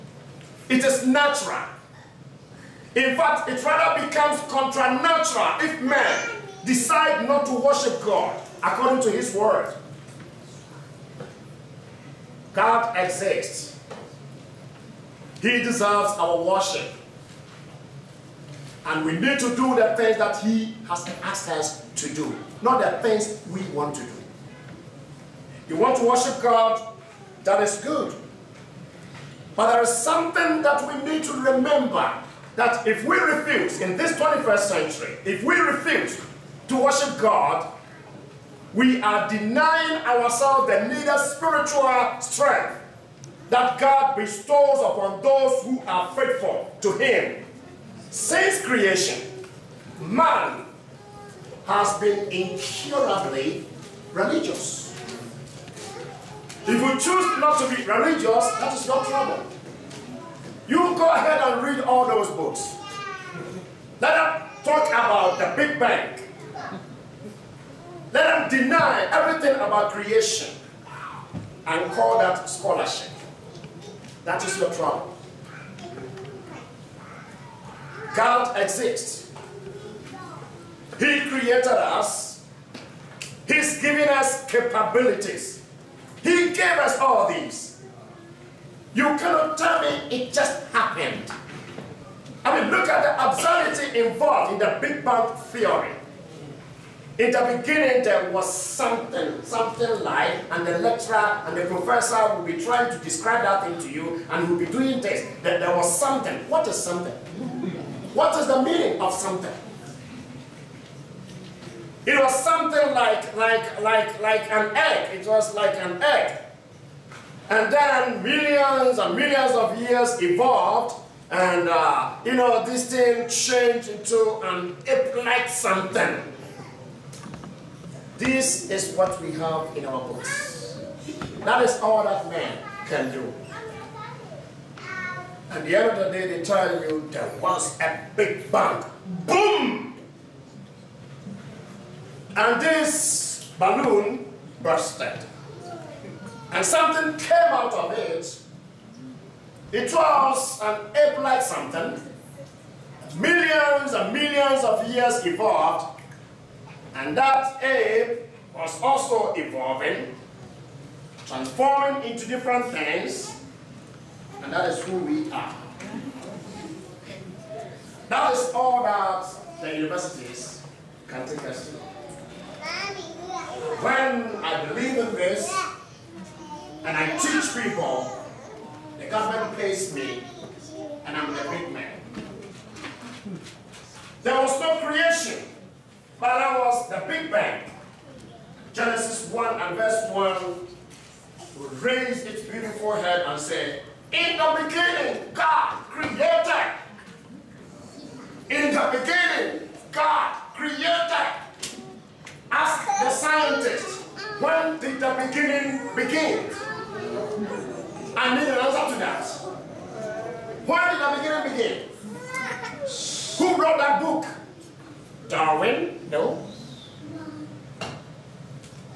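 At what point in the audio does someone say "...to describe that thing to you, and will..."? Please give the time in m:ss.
1:42.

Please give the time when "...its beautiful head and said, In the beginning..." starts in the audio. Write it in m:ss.
3:12.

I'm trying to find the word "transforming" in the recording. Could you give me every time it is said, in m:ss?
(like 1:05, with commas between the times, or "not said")
2:41.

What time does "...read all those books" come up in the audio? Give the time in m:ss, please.
1:01.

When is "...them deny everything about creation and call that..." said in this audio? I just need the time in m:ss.
1:08.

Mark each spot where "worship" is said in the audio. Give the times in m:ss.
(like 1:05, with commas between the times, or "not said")
0:07, 0:16, 0:26, 0:36.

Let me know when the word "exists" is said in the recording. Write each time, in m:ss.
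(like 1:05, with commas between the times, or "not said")
0:12, 1:18.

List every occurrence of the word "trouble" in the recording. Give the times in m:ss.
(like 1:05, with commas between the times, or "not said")
0:59, 1:14.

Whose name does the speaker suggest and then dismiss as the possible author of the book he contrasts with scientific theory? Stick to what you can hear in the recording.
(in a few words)
Darwin.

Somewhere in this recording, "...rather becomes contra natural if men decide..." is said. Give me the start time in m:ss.
0:03.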